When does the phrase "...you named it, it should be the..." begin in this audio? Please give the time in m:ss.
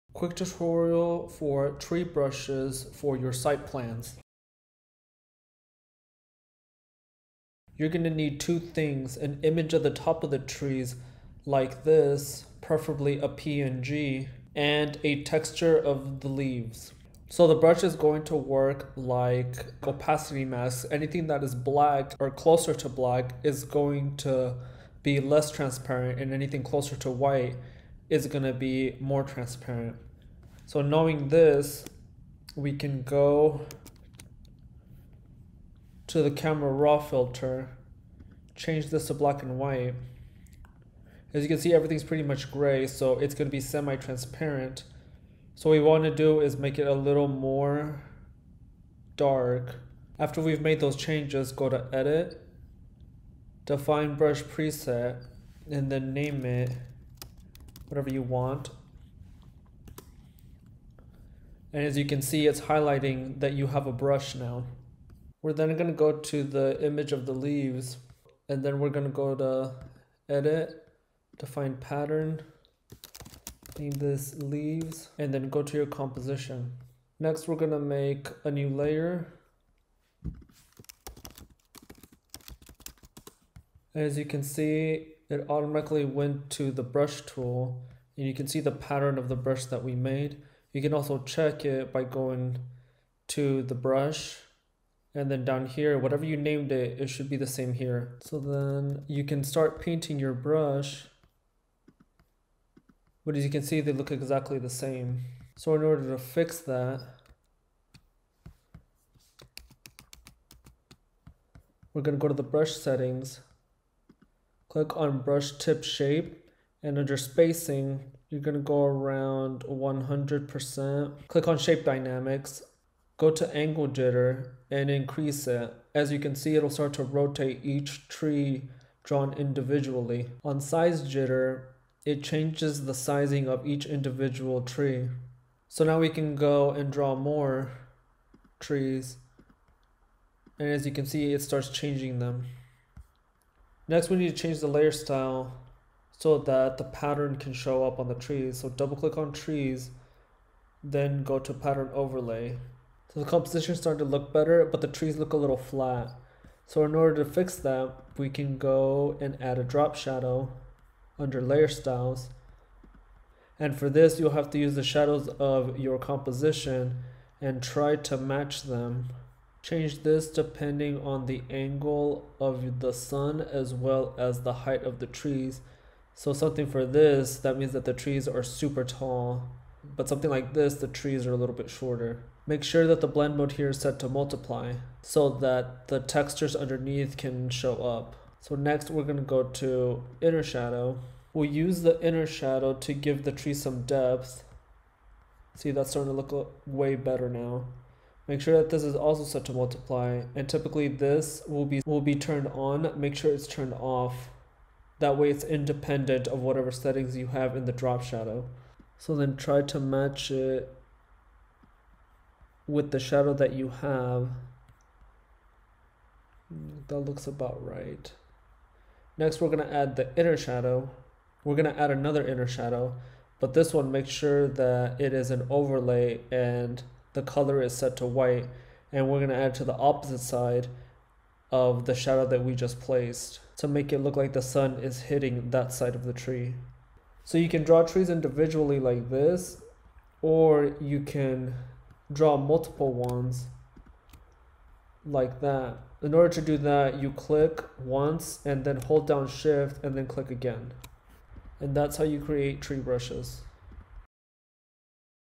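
1:36.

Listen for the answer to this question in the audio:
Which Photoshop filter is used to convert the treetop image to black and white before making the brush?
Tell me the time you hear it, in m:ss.
0:36.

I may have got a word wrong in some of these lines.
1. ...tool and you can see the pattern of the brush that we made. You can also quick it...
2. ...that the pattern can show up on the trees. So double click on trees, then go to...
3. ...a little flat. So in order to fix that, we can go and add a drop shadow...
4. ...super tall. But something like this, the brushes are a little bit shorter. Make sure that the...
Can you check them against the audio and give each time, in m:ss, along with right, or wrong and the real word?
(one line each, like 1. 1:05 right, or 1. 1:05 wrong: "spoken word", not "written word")
1. 1:27 wrong: "check", not "quick"
2. 2:26 right
3. 2:35 right
4. 2:58 wrong: "trees", not "brushes".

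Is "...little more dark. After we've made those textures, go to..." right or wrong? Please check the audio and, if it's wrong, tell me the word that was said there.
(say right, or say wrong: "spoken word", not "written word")
wrong: "changes", not "textures".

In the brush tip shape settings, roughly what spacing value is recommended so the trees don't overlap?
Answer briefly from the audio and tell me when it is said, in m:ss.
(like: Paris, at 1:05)
100%, at 1:59.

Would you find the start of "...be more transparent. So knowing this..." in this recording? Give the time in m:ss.
0:28.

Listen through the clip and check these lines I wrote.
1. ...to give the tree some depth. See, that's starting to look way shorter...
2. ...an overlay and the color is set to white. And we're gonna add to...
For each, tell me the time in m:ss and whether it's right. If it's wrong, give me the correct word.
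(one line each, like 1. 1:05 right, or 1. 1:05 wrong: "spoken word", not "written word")
1. 3:12 wrong: "better", not "shorter"
2. 3:45 right.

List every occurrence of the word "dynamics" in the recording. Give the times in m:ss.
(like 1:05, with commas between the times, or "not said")
2:01.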